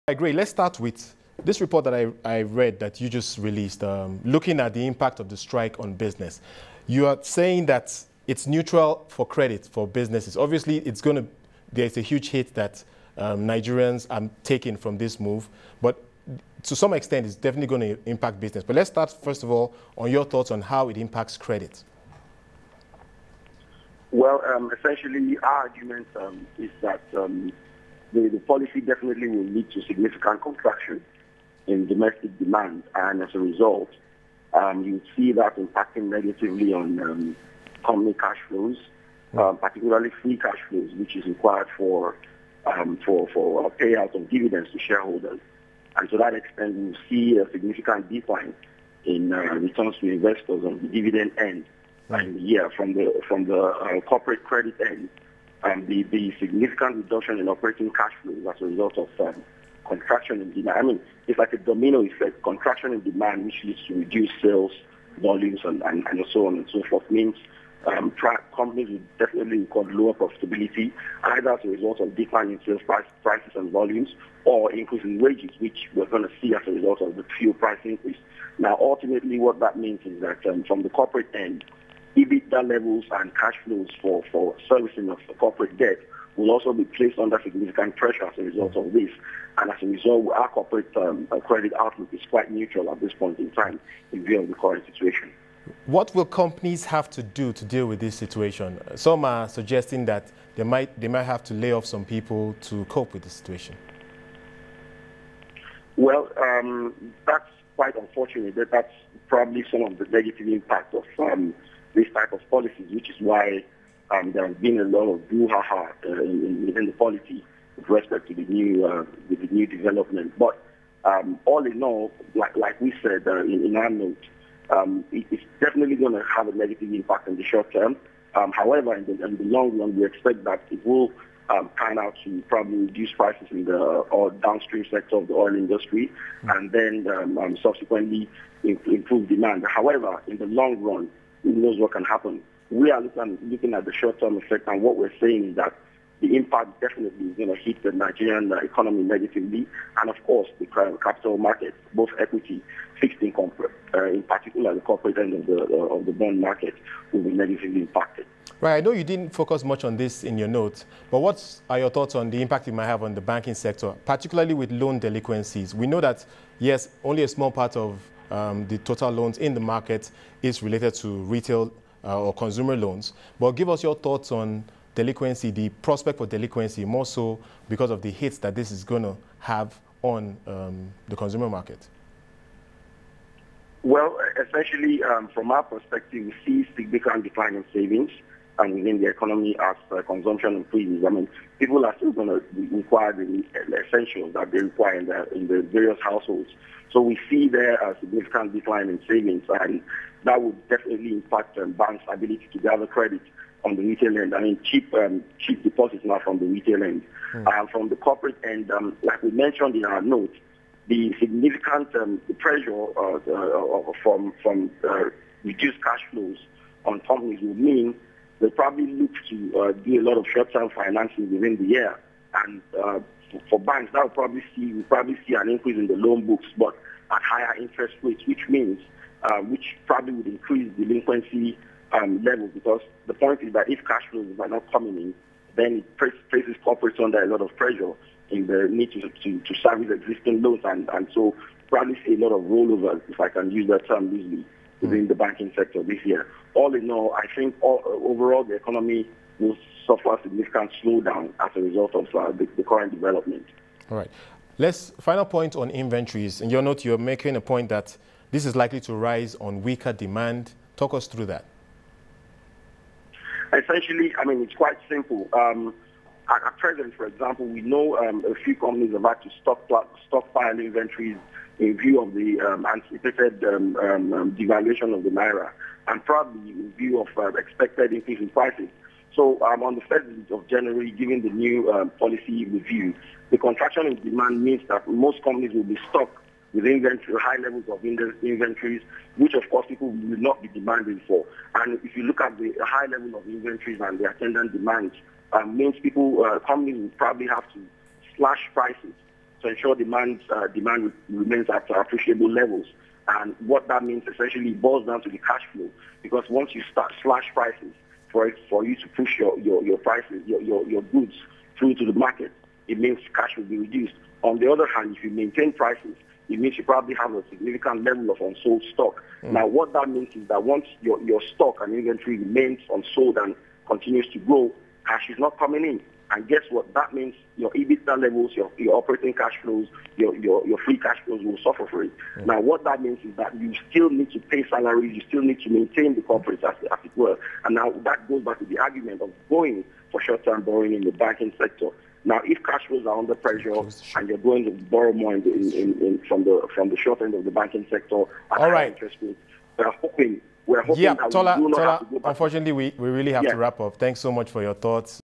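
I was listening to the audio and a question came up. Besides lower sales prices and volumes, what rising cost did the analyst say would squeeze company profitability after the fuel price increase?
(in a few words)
Wages.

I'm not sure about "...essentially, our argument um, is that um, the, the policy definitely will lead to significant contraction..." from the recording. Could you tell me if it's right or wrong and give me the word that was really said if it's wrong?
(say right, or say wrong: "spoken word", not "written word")
right.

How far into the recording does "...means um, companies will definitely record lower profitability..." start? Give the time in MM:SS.
01:07.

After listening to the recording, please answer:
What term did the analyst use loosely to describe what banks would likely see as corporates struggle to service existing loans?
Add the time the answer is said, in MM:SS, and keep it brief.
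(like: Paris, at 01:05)
Rollovers, at 04:02.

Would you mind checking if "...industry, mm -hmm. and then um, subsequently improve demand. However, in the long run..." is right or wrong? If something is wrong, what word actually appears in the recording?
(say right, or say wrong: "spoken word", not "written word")
right.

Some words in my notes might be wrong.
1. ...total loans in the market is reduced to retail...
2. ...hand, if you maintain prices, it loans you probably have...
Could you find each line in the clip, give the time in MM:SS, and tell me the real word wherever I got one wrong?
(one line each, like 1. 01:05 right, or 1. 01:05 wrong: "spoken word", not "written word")
1. 02:48 wrong: "related", not "reduced"
2. 05:14 wrong: "means", not "loans".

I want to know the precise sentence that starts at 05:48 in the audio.
interest rates, we're hoping we're hoping that Tola, we do not Tola, have to go back.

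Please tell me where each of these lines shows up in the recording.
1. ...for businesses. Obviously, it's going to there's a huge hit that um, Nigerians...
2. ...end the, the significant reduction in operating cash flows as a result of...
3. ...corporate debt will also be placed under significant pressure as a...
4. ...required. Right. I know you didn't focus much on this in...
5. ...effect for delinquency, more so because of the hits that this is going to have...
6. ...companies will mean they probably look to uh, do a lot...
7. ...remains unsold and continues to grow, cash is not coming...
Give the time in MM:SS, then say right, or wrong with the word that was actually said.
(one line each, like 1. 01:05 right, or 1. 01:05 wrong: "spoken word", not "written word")
1. 00:09 right
2. 00:54 right
3. 01:25 right
4. 02:37 wrong: "impacted", not "required"
5. 02:55 wrong: "prospect", not "effect"
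6. 03:37 right
7. 05:22 right.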